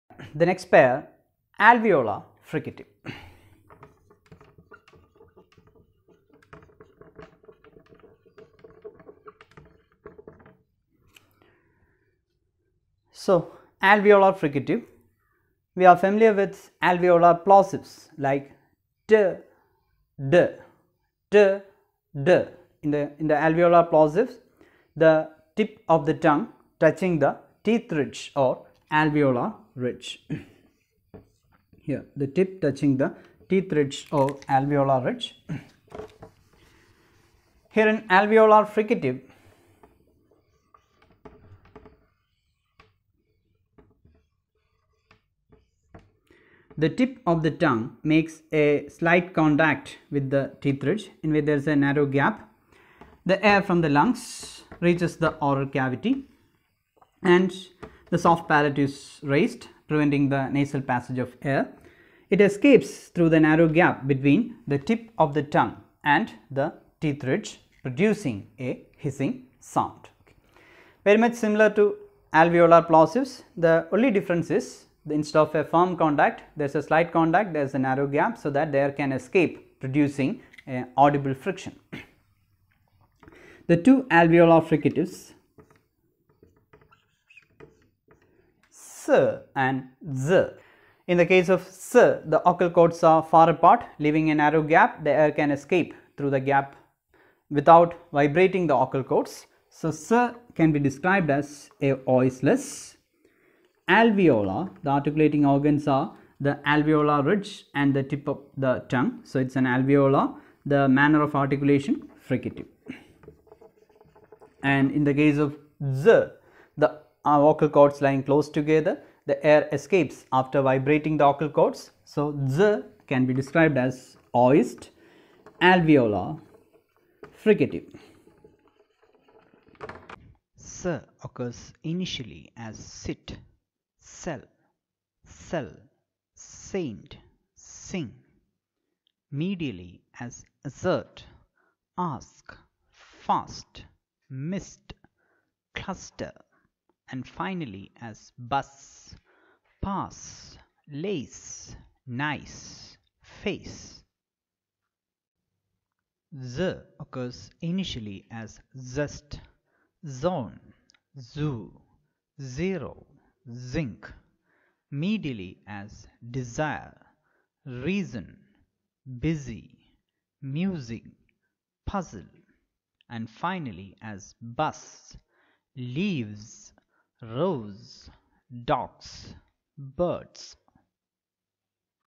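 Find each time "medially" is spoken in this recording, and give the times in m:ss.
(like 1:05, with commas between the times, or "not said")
2:19, 2:44.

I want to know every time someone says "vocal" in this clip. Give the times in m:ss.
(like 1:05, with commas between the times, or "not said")
1:32, 1:38, 1:57, 2:01.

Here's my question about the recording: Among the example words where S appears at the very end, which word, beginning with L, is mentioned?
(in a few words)
lace.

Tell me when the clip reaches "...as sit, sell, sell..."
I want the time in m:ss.
2:12.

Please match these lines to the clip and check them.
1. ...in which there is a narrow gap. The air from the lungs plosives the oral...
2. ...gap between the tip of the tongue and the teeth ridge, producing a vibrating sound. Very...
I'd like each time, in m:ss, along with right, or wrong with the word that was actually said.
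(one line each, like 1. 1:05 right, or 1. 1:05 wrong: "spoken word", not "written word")
1. 0:51 wrong: "reaches", not "plosives"
2. 1:03 wrong: "hissing", not "vibrating".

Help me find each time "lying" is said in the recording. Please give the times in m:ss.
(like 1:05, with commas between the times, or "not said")
1:58.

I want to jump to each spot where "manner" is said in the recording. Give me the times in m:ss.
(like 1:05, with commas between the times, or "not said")
1:50.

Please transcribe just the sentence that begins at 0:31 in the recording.
Here, the tip touching the teeth ridge or alveolar ridge.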